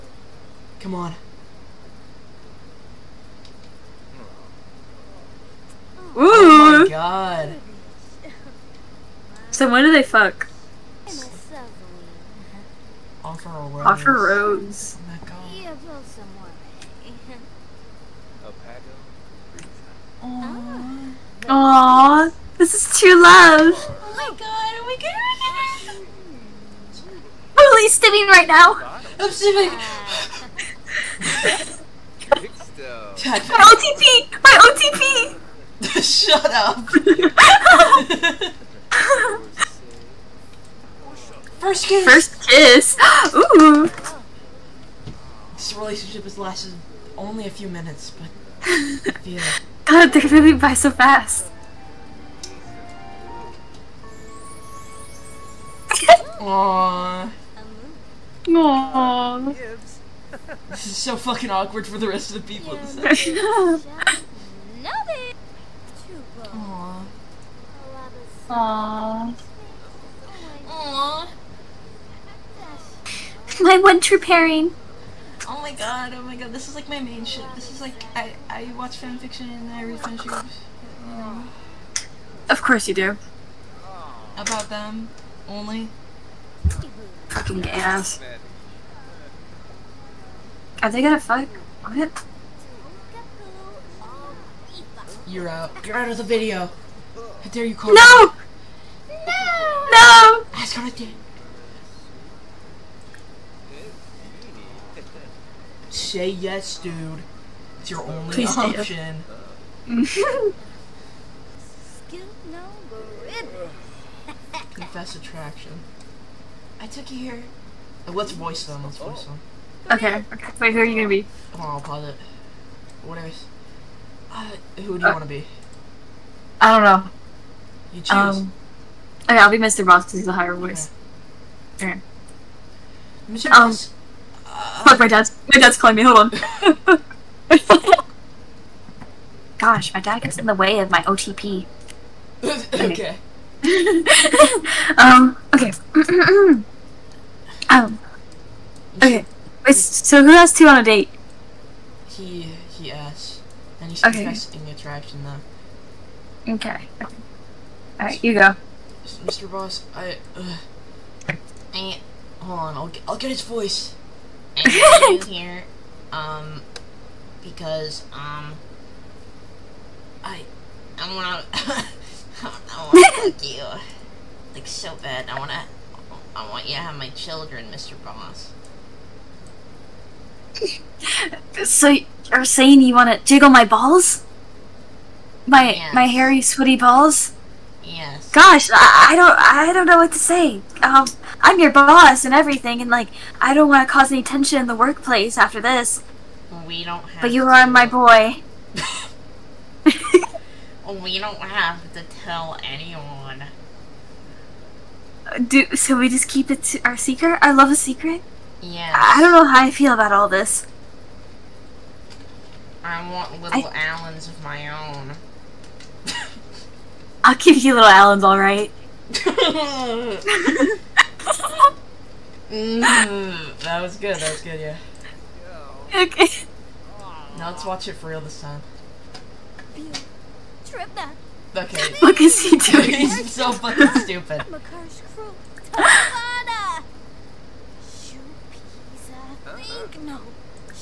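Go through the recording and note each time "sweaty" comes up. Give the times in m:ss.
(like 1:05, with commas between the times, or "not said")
3:06.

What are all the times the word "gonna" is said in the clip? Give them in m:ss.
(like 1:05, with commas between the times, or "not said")
0:24, 1:31, 2:00.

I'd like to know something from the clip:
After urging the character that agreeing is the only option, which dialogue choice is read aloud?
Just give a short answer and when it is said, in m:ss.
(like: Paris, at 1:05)
Confess attraction, at 1:54.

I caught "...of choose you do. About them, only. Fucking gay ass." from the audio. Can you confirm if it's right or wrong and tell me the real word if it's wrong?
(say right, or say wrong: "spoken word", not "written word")
wrong: "course", not "choose".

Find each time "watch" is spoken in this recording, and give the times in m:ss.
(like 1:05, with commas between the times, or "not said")
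1:18, 3:47.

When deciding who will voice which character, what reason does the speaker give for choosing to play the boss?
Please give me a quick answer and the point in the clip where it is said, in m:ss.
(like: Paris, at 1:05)
higher voice, at 2:10.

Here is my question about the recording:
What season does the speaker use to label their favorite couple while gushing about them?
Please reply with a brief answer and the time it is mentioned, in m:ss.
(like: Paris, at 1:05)
winter, at 1:13.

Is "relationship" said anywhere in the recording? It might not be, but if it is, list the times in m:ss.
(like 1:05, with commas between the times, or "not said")
0:45.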